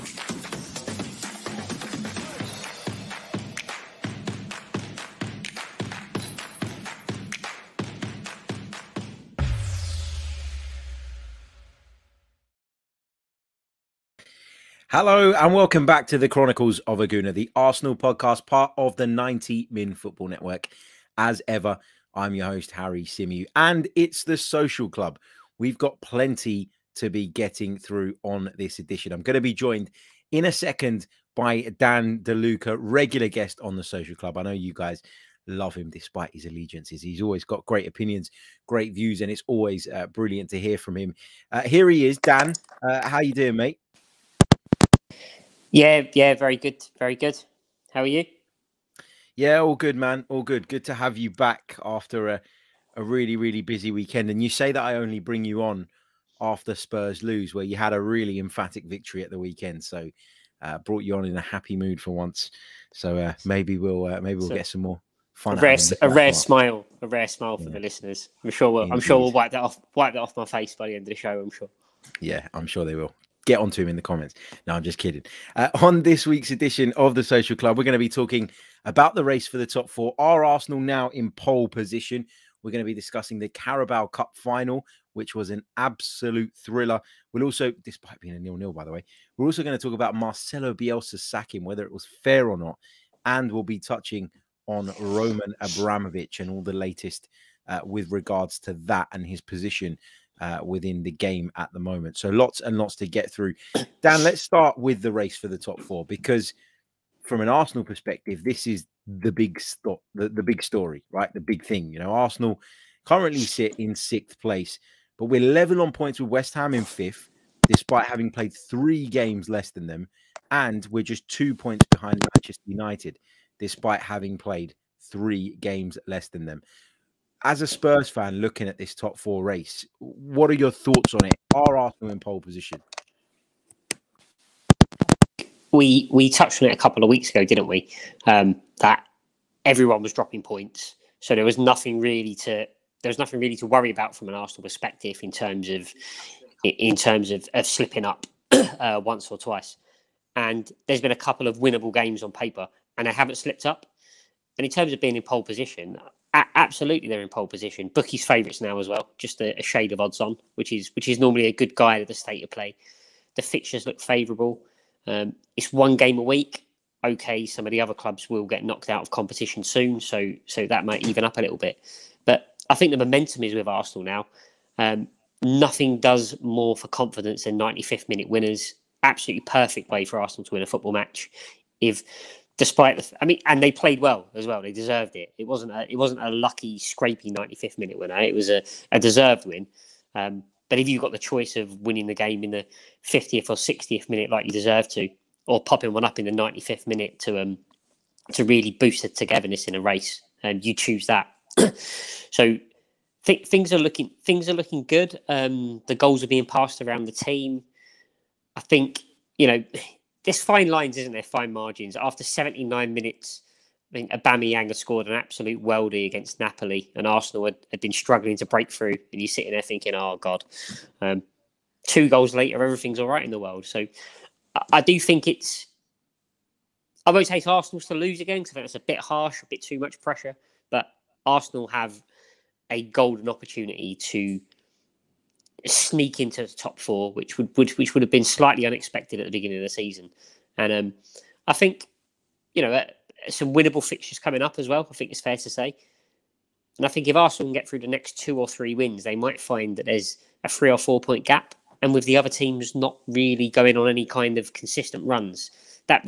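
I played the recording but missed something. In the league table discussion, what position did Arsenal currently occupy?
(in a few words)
Sixth.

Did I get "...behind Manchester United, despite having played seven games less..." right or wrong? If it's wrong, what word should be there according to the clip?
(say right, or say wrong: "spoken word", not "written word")
wrong: "three", not "seven".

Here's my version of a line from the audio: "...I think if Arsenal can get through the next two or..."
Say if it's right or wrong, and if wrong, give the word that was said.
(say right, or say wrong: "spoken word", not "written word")
right.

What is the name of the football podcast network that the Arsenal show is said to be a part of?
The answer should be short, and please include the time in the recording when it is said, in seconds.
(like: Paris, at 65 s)
90 Min Football Network, at 19 s.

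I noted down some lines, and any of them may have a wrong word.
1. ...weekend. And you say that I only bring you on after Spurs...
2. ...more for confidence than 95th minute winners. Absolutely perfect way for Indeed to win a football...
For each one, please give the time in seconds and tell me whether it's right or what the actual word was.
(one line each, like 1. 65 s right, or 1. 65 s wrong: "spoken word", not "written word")
1. 53 s right
2. 176 s wrong: "Arsenal", not "Indeed".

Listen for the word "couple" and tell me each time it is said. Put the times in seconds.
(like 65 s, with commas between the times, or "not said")
136 s, 151 s.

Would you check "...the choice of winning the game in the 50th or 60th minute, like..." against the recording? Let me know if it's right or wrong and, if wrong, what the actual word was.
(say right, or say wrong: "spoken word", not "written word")
right.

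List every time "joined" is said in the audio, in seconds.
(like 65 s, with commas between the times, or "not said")
29 s.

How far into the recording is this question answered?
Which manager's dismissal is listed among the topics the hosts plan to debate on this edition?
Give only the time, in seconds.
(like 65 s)
90 s.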